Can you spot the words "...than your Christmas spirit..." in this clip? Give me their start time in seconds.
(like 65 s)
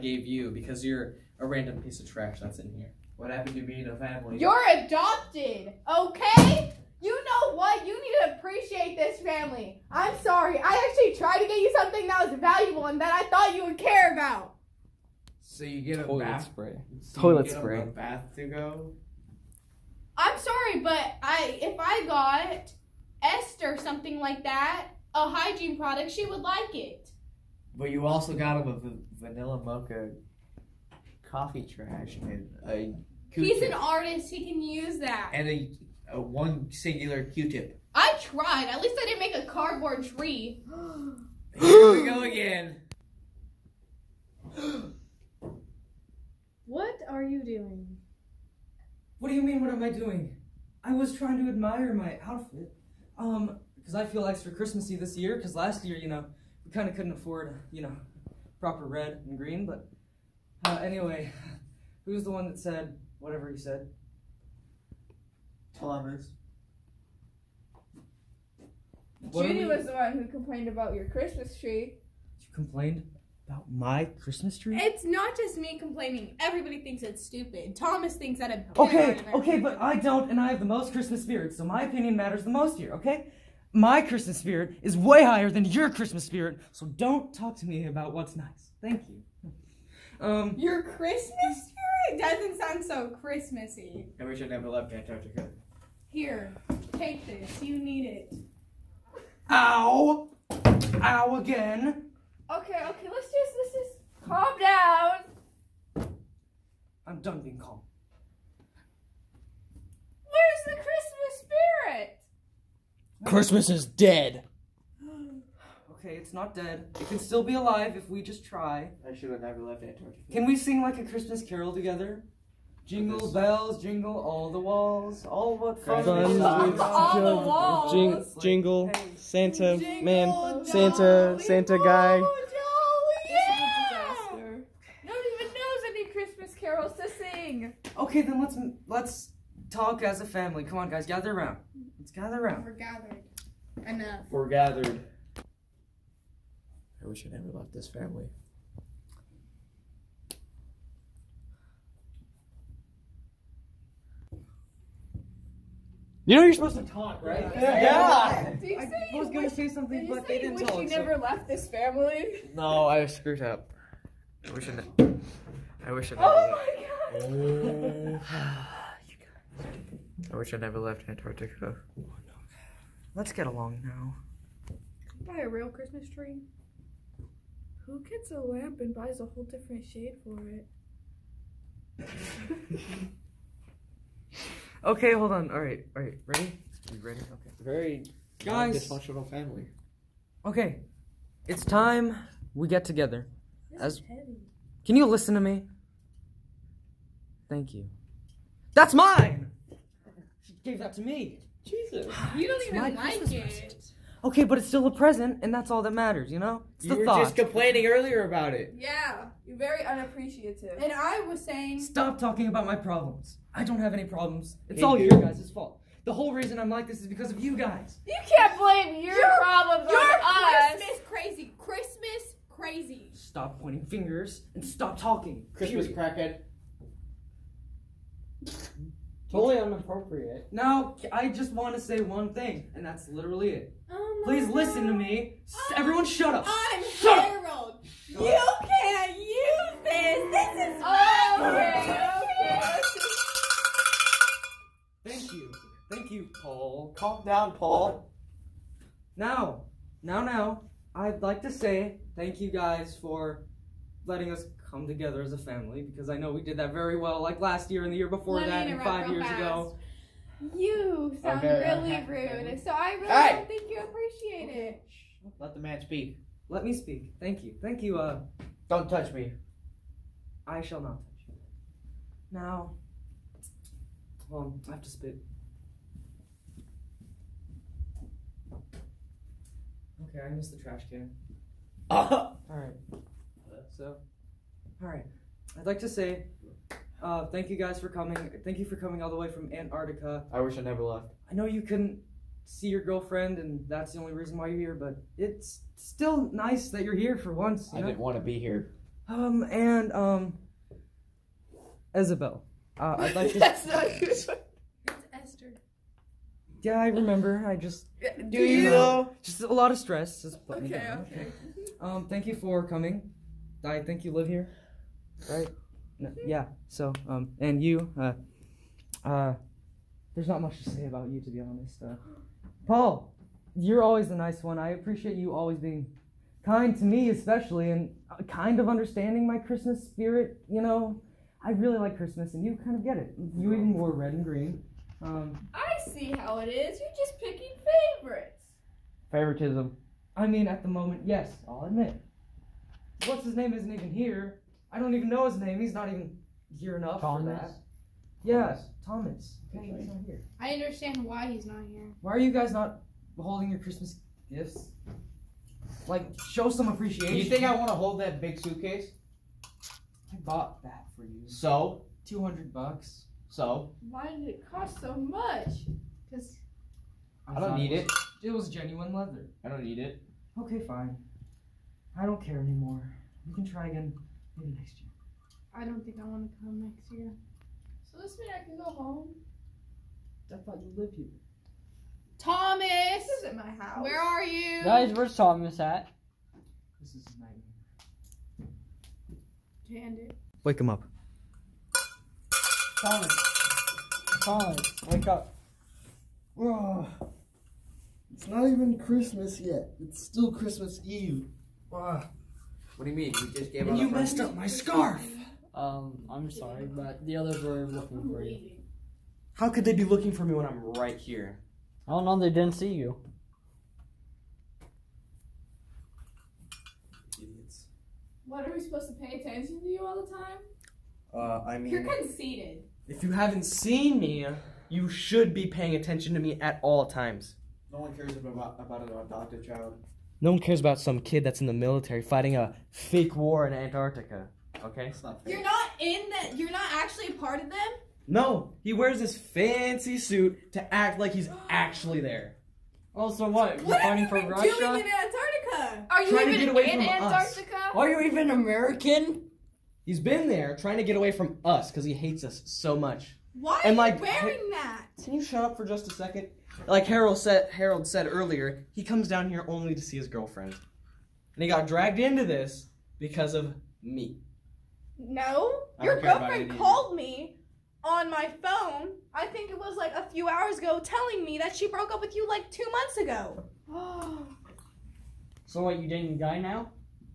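85 s.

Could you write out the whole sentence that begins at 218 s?
You can't blame your, problem problems your on Christmas crazy.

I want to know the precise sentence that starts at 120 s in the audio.
Can we sing like a Christmas carol together?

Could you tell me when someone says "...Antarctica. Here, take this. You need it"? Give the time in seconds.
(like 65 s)
94 s.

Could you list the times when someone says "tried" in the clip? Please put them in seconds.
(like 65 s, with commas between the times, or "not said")
11 s, 38 s.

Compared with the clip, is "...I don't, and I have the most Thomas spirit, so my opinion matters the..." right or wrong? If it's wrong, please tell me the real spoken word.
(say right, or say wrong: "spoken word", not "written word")
wrong: "Christmas", not "Thomas".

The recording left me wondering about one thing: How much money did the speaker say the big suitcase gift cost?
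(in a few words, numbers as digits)
$200.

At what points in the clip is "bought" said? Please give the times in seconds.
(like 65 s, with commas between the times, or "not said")
360 s.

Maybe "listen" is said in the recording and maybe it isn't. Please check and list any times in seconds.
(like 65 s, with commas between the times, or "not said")
195 s, 234 s.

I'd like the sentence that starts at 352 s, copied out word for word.
Why are you guys not holding your Christmas gifts?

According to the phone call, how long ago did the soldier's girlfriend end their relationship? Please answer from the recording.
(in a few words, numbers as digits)
2 months ago.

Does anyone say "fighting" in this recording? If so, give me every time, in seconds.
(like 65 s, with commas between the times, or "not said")
432 s, 443 s.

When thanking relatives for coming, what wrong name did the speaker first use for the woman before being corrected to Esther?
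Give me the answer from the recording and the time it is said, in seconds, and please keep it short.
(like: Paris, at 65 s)
Isabel, at 301 s.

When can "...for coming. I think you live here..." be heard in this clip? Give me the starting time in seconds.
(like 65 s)
312 s.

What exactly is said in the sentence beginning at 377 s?
So this means I can go home.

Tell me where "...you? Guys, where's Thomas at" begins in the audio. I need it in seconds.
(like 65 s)
384 s.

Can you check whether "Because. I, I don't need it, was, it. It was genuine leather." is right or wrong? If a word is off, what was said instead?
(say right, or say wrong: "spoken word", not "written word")
right.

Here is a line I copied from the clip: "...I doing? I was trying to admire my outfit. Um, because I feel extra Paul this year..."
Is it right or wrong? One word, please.
wrong.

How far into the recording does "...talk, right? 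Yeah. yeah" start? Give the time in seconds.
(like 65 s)
156 s.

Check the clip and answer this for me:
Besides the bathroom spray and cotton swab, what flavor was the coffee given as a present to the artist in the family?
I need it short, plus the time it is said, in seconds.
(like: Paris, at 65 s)
vanilla mocha, at 29 s.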